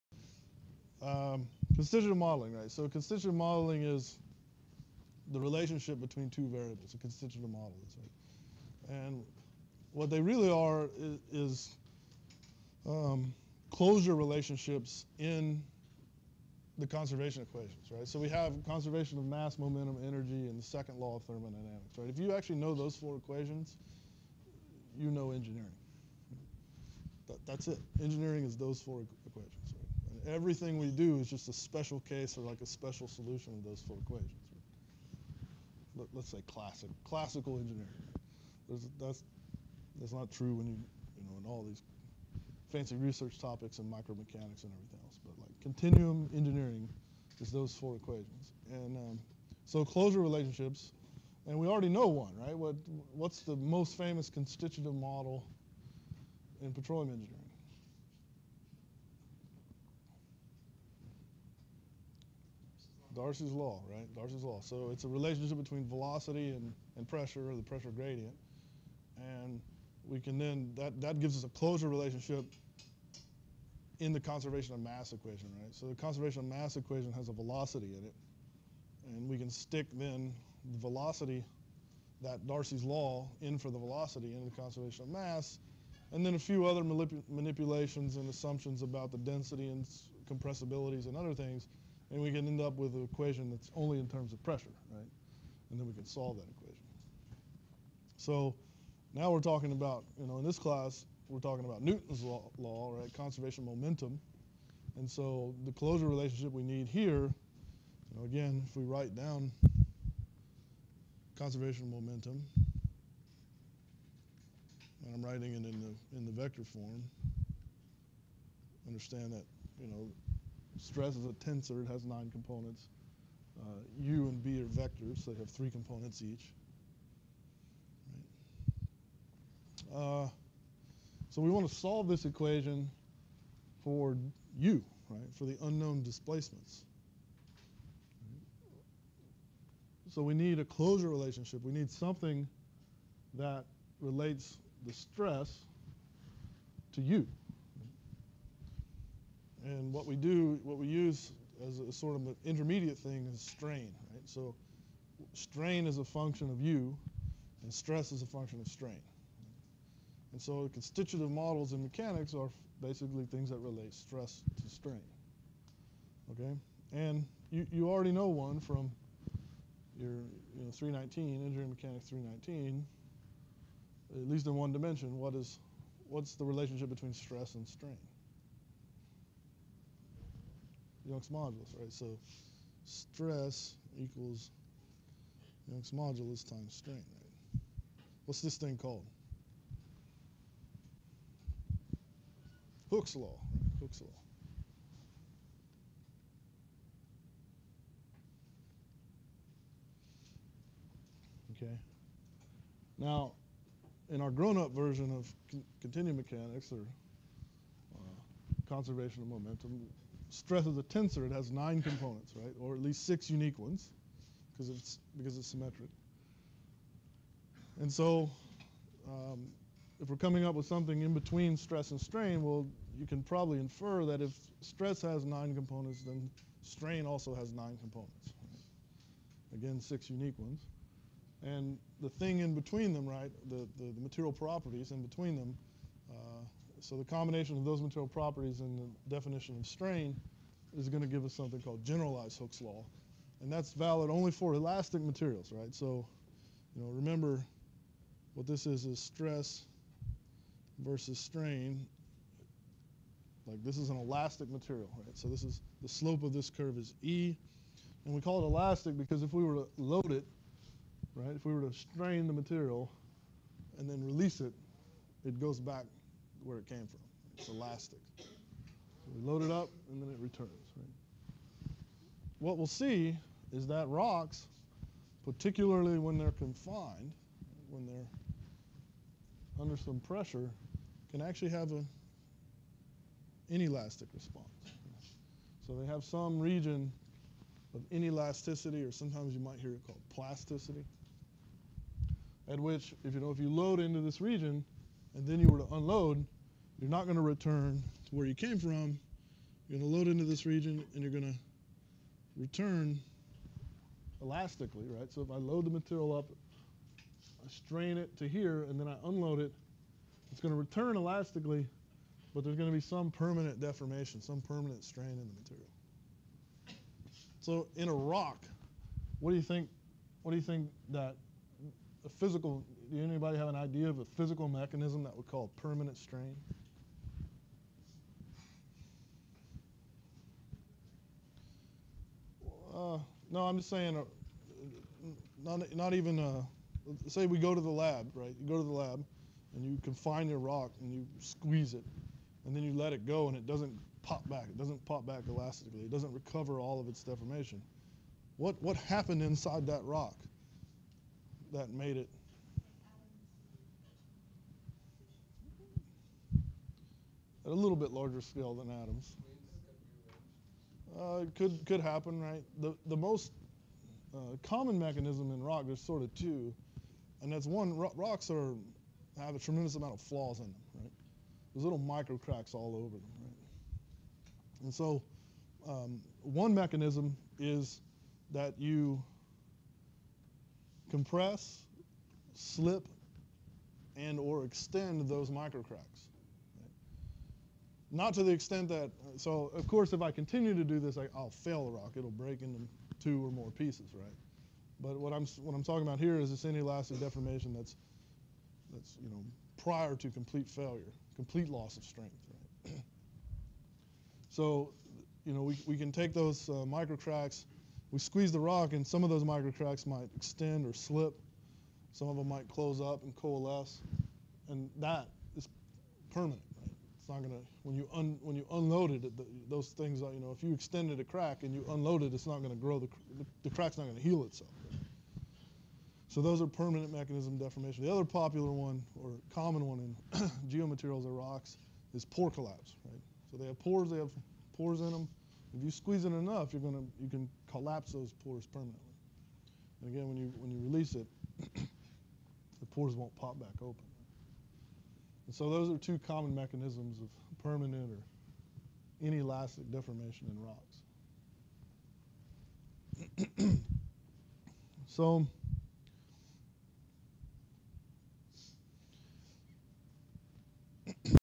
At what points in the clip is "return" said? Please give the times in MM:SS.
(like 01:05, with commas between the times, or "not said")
04:30, 04:57, 05:02, 05:10.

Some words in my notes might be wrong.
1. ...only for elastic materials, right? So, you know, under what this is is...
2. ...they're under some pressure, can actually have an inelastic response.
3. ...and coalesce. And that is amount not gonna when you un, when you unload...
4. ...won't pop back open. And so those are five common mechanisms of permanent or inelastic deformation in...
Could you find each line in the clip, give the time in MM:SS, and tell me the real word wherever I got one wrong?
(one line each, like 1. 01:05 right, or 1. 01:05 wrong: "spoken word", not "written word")
1. 04:04 wrong: "remember", not "under"
2. 04:37 right
3. 06:53 wrong: "permanent", not "amount"
4. 07:22 wrong: "two", not "five".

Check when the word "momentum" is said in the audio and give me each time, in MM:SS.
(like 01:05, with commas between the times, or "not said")
00:19, 01:43, 01:51, 03:29.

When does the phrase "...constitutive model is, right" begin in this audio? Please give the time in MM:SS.
00:06.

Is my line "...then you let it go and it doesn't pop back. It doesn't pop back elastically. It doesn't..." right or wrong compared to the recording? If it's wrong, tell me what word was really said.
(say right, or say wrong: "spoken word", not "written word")
right.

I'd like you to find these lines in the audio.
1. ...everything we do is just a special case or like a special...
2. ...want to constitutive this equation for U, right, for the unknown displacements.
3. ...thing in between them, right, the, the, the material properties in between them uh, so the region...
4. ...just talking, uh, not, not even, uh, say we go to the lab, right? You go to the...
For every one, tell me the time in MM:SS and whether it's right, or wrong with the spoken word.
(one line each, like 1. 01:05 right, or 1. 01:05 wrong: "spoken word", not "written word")
1. 00:30 right
2. 02:11 wrong: "solve", not "constitutive"
3. 03:52 wrong: "combination", not "region"
4. 05:33 wrong: "saying", not "talking".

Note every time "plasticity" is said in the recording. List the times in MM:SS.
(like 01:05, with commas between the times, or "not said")
04:50.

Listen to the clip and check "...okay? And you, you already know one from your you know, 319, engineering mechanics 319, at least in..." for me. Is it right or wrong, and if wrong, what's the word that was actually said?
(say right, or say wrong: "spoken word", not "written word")
right.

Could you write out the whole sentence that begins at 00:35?
Let, us say classic, classical engineering.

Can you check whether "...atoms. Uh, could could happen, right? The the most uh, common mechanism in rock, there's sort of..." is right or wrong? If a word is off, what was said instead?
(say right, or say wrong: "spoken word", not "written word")
right.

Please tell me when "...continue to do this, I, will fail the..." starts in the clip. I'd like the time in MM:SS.
06:30.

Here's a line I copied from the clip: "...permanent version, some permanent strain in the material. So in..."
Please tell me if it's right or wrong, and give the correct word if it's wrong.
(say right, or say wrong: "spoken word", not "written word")
wrong: "deformation", not "version".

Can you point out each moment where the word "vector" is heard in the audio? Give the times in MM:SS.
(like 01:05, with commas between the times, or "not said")
01:56, 02:04.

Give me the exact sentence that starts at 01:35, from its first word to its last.
And then we can solve that equation.